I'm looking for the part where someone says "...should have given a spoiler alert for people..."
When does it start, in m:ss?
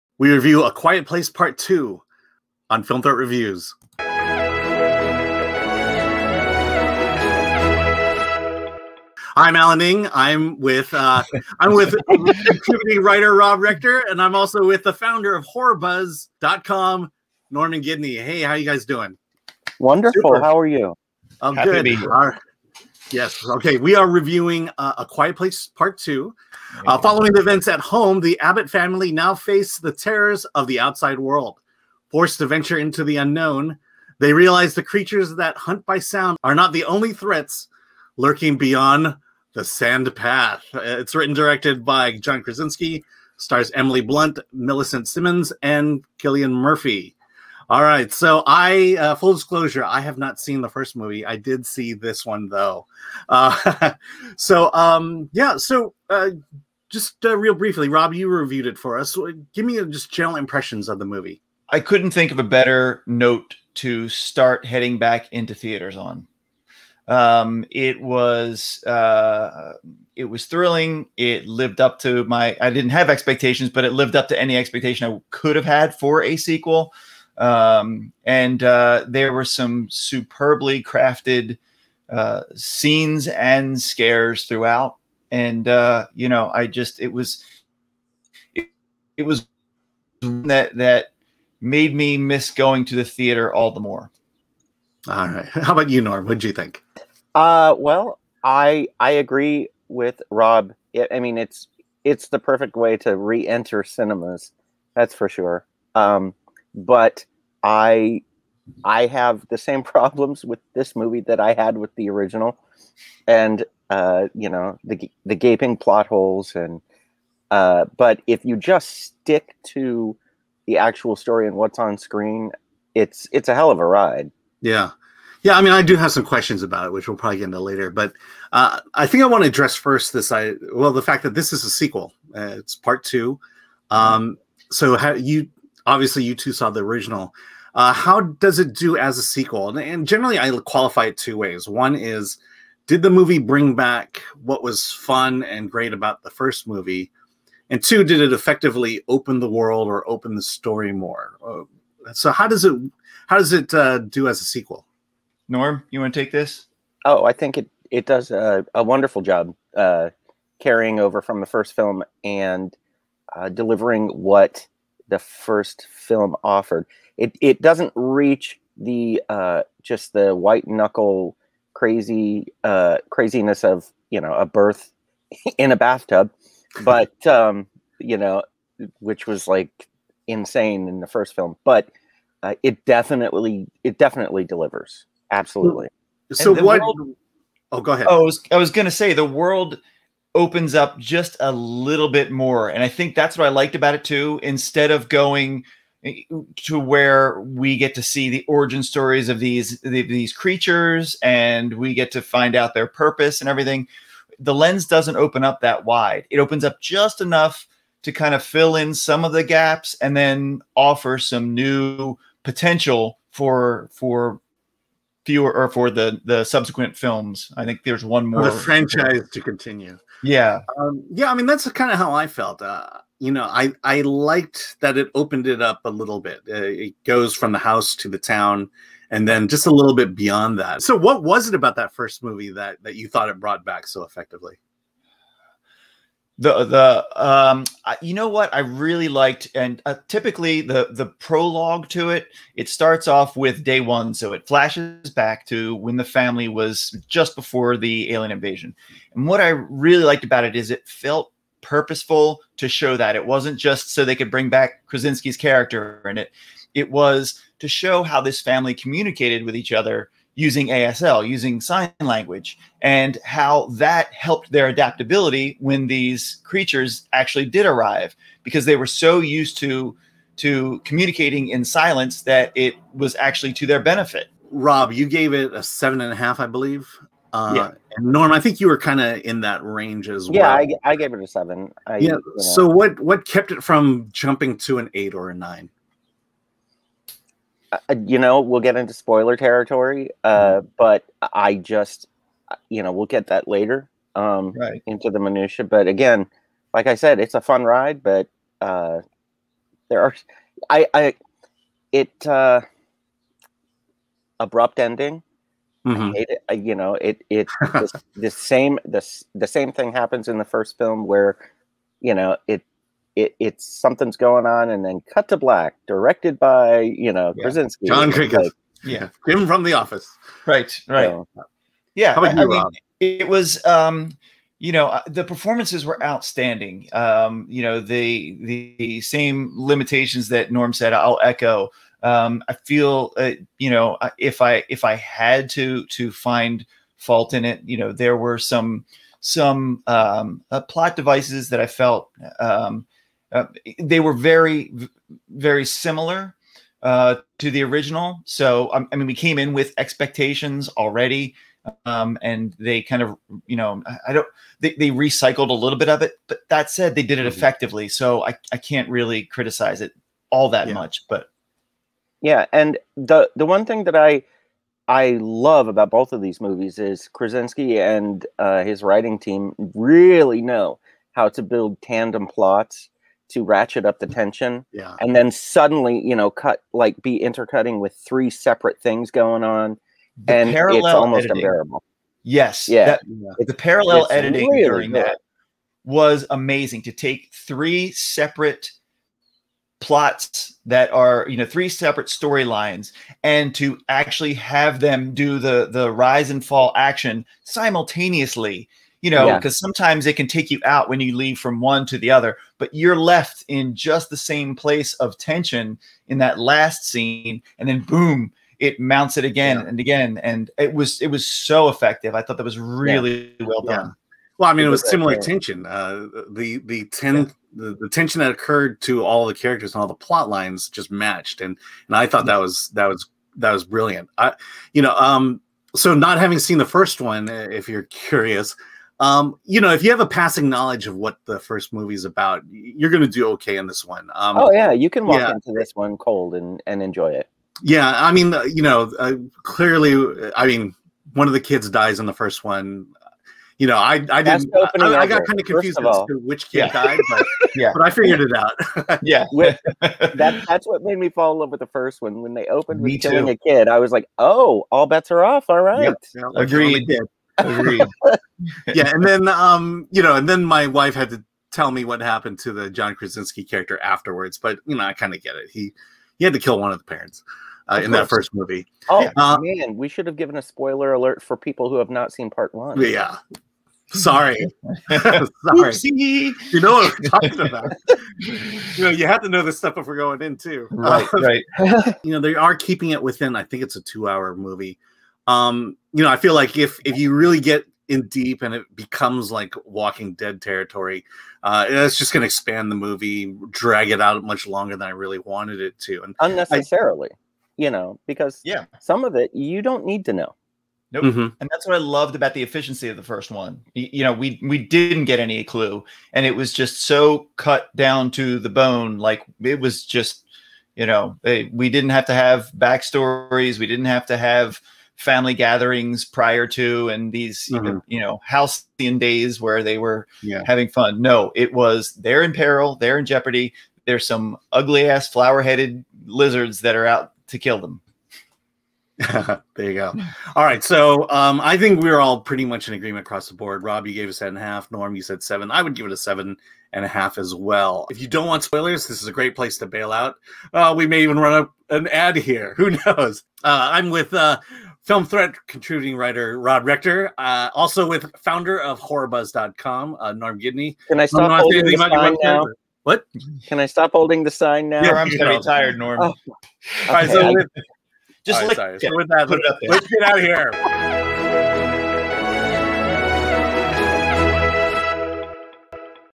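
7:49.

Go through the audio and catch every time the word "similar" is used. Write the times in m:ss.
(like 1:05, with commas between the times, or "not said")
5:45, 6:54.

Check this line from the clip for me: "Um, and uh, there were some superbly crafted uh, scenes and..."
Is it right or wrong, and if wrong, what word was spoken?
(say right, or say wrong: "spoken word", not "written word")
right.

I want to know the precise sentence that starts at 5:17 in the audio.
Krasinski, John Cricket, like, yeah, him from The Office, right, right, yeah.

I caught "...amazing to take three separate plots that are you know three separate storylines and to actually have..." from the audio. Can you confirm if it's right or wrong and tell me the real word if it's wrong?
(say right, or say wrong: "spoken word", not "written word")
right.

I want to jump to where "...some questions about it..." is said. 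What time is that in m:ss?
2:06.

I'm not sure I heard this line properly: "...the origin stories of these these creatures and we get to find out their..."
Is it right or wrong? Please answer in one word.
right.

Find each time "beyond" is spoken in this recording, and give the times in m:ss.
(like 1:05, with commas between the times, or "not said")
0:38, 3:50.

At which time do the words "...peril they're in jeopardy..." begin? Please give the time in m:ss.
8:42.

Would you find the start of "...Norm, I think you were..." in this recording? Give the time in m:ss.
4:38.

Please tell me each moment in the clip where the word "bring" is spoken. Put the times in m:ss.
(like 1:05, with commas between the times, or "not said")
2:23, 4:14.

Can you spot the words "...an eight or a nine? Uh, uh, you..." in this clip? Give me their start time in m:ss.
4:44.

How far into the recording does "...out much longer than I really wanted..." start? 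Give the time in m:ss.
8:14.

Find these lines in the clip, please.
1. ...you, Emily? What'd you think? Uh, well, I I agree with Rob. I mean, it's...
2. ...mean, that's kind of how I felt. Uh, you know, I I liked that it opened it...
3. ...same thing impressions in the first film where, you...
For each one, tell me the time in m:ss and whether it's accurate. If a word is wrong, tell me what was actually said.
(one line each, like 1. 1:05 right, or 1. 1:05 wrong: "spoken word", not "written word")
1. 1:35 wrong: "Norm", not "Emily"
2. 3:41 right
3. 5:09 wrong: "happens", not "impressions".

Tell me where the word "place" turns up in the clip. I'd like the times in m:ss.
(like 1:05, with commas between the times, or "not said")
0:01, 0:25, 6:44, 8:59.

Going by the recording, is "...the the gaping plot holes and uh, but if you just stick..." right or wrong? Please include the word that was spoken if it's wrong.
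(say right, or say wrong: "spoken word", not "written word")
right.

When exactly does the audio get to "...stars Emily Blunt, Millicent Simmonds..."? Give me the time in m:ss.
0:43.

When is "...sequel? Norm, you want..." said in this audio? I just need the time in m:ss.
2:34.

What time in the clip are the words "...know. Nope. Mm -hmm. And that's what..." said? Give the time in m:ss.
8:20.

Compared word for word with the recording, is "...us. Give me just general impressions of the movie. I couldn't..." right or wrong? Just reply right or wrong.
right.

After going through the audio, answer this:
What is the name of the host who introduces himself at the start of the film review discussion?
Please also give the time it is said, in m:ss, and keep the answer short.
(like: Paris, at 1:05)
Alan Ng, at 0:09.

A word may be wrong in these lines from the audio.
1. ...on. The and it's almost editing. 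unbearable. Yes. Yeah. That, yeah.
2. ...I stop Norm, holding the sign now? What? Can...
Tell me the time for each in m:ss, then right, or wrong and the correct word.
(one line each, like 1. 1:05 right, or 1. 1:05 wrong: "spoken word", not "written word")
1. 6:19 right
2. 9:10 right.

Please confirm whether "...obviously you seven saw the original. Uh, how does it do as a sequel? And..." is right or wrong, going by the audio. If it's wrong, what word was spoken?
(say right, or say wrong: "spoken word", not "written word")
wrong: "two", not "seven".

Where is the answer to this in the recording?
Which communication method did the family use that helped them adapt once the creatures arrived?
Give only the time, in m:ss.
4:20.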